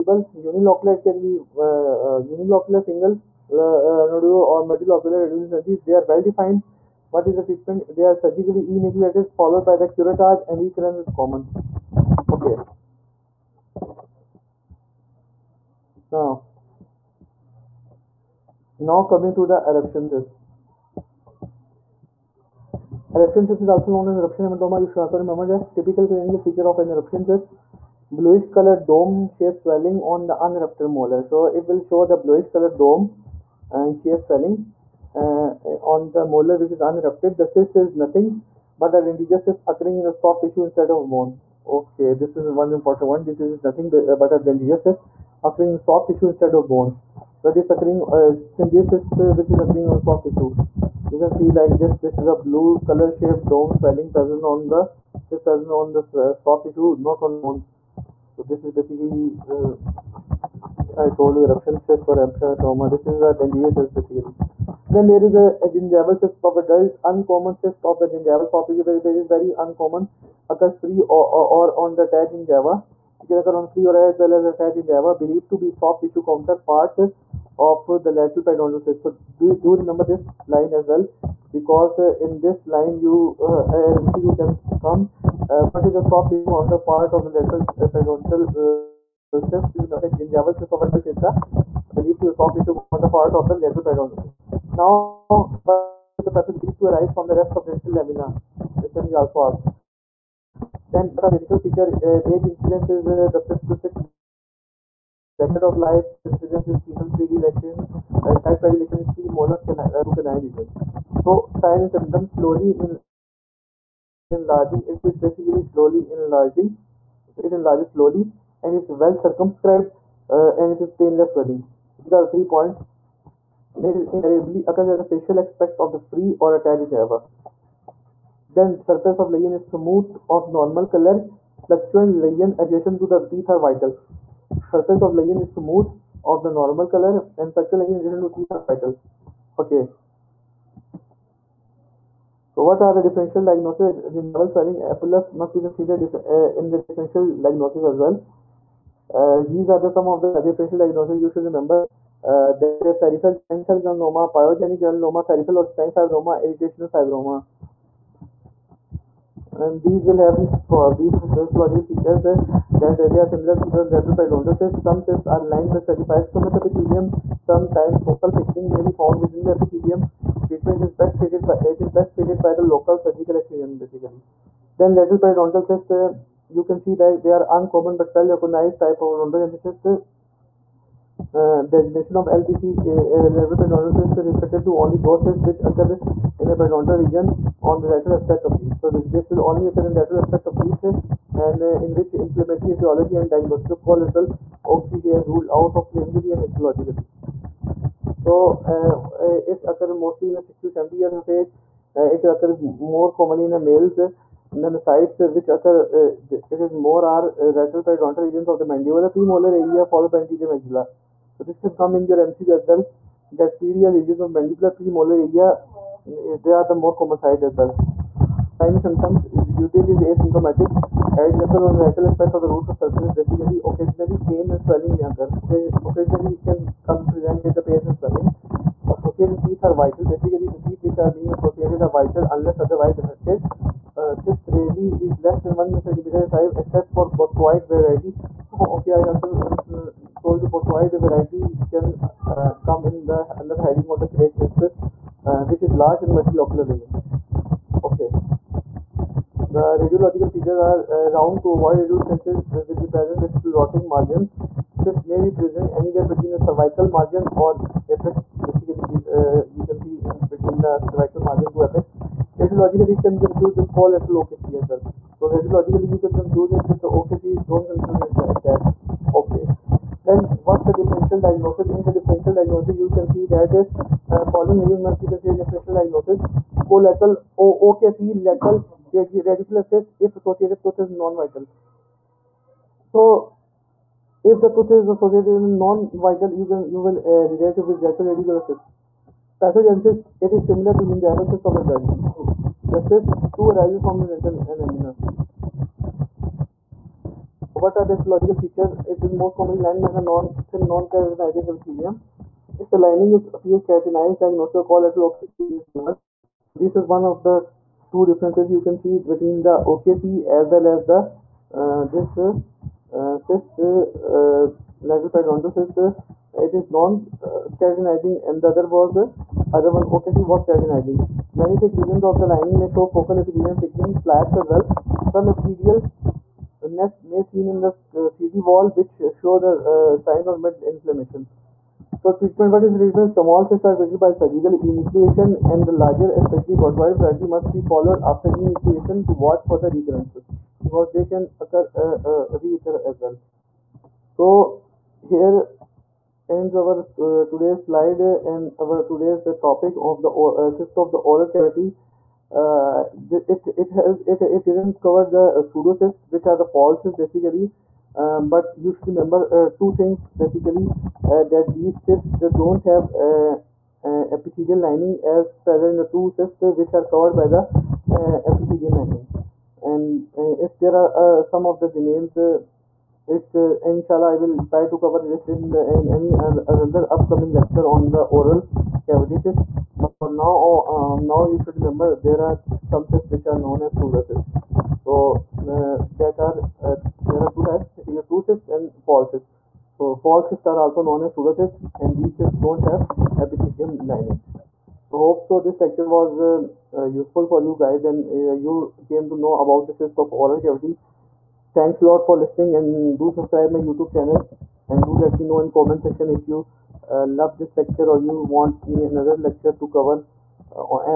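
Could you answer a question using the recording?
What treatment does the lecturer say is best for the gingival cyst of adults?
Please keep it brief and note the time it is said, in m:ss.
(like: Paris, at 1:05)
Local surgical excision, at 2:52.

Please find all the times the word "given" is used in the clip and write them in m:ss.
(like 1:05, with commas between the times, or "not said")
5:05.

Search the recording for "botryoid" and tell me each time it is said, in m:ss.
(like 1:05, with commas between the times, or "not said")
4:00, 5:36.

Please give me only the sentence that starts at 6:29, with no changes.
So false cysts are also known as pseudocysts, and these cysts don't have epithelium lining.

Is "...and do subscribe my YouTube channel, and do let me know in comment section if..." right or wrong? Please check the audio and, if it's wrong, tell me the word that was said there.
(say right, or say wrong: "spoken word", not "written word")
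right.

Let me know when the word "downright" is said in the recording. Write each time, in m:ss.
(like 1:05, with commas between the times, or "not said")
not said.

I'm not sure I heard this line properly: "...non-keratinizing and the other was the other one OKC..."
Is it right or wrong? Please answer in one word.
right.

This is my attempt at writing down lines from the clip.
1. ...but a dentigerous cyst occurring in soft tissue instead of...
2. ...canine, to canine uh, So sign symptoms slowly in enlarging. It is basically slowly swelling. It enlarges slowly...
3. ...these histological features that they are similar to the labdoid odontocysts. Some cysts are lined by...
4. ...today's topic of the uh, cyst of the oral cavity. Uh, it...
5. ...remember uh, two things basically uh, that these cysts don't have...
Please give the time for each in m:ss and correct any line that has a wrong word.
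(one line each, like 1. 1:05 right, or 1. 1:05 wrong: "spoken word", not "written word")
1. 0:43 right
2. 1:49 wrong: "enlarging", not "swelling"
3. 2:40 right
4. 5:48 right
5. 5:58 right.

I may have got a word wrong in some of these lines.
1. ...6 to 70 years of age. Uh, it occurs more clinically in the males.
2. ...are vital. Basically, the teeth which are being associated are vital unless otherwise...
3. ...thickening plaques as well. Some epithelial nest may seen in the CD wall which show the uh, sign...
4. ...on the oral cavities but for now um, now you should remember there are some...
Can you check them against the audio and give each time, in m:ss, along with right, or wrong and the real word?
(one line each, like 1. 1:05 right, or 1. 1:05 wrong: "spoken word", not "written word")
1. 3:20 wrong: "commonly", not "clinically"
2. 3:49 right
3. 5:23 right
4. 6:17 right.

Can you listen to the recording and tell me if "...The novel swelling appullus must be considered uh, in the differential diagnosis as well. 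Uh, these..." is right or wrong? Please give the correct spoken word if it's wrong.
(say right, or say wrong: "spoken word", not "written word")
right.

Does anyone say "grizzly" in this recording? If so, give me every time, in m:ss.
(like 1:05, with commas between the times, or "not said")
not said.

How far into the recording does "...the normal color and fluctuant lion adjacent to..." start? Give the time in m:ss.
2:16.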